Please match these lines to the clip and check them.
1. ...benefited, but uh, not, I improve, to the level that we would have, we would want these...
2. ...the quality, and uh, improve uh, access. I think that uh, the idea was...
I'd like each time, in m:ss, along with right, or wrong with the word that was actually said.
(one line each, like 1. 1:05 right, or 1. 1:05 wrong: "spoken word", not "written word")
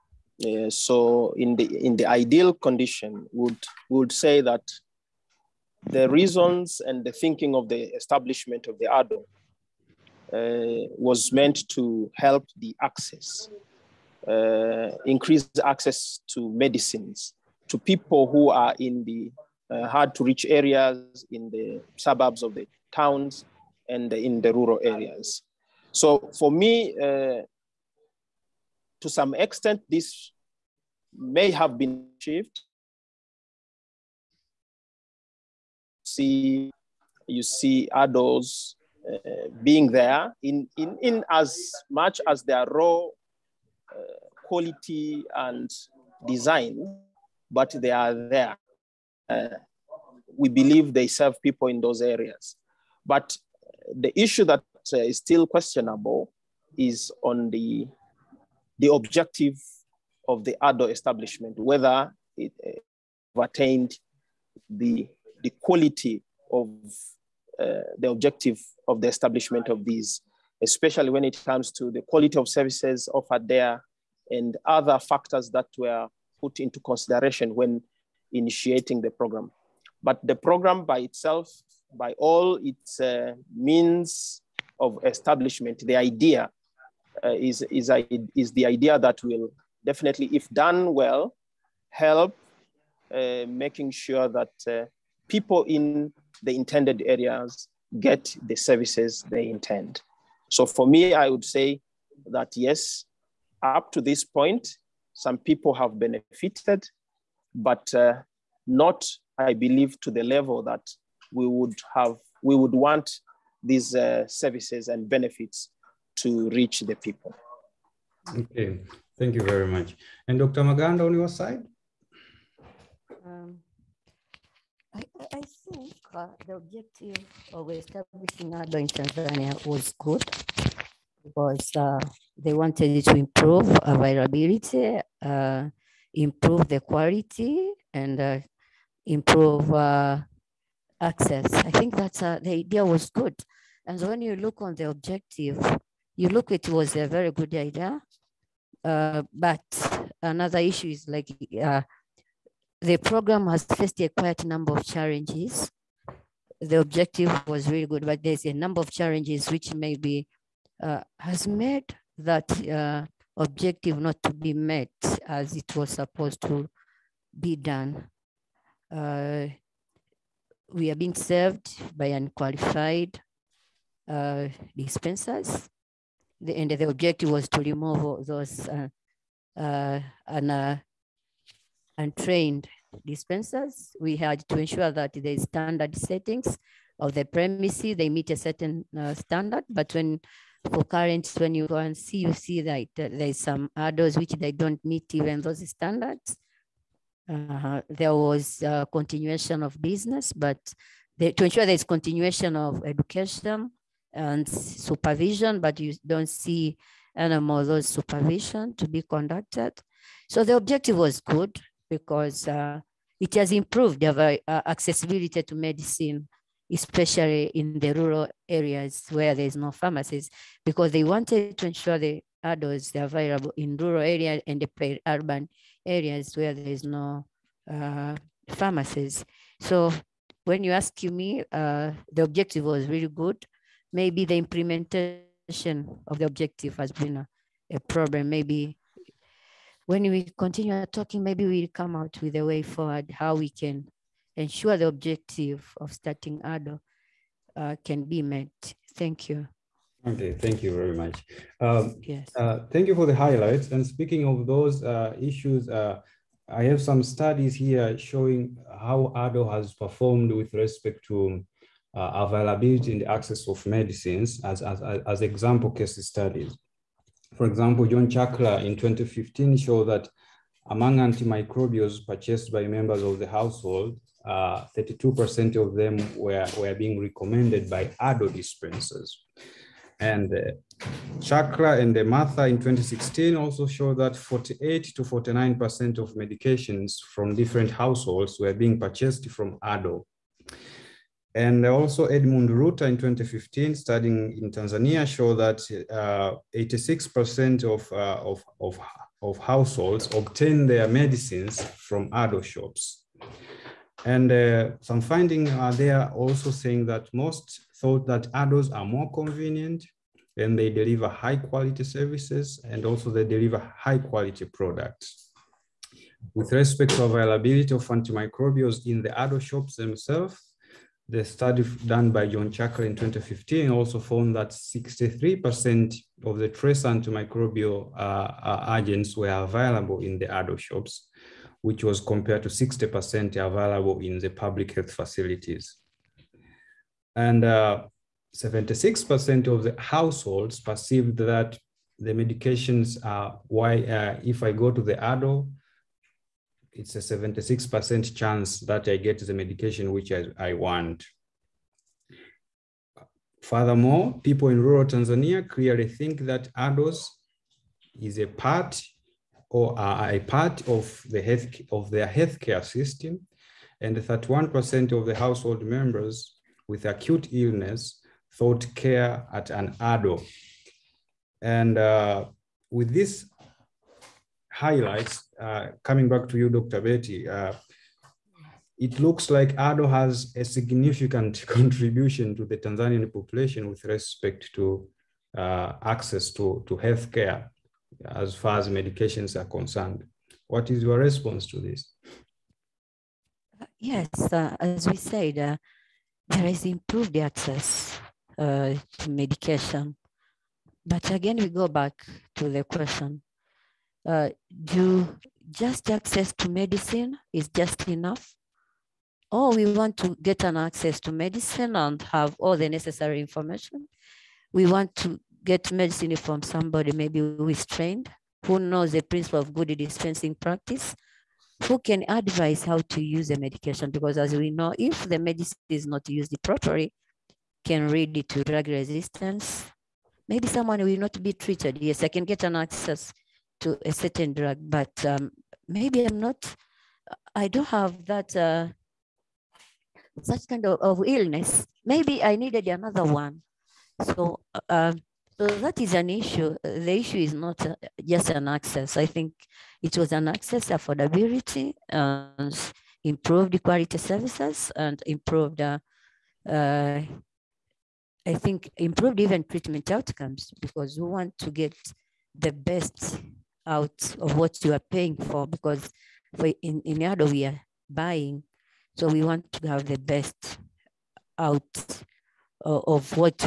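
1. 1:45 wrong: "believe", not "improve"
2. 2:16 right.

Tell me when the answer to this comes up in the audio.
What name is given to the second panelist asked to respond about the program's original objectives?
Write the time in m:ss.
2:00.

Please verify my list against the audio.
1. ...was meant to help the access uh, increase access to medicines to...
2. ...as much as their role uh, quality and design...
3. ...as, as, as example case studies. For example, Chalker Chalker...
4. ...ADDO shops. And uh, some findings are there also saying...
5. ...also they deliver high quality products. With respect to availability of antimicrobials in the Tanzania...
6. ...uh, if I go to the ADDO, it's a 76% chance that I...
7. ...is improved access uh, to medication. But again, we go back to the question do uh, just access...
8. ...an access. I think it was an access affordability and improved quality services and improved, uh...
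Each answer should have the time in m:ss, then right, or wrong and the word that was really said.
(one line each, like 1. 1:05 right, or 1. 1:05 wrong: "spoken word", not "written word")
1. 0:10 right
2. 0:41 right
3. 4:24 wrong: "John", not "Chalker"
4. 5:02 right
5. 5:12 wrong: "ADDO", not "Tanzania"
6. 5:43 right
7. 6:36 right
8. 7:28 right.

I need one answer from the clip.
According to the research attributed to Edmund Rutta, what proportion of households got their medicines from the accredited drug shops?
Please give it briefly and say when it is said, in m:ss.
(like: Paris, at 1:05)
86%, at 4:56.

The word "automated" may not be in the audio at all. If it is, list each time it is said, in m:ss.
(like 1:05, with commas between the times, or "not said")
not said.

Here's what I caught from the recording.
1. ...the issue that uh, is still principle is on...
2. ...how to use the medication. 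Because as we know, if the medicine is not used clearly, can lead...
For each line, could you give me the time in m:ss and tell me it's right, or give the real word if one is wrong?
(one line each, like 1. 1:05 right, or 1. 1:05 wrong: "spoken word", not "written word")
1. 0:53 wrong: "questionable", not "principle"
2. 7:02 wrong: "properly", not "clearly".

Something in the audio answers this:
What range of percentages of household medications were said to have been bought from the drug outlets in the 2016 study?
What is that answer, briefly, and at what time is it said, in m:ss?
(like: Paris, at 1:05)
48 to 49%, at 4:44.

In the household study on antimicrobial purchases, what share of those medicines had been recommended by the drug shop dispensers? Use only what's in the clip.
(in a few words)
32%.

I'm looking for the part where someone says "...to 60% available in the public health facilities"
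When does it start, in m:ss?
5:32.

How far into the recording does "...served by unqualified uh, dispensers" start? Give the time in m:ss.
2:51.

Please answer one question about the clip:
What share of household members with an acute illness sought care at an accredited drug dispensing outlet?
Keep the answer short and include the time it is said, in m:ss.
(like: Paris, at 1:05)
31%, at 6:03.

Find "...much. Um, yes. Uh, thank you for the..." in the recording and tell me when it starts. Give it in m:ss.
4:10.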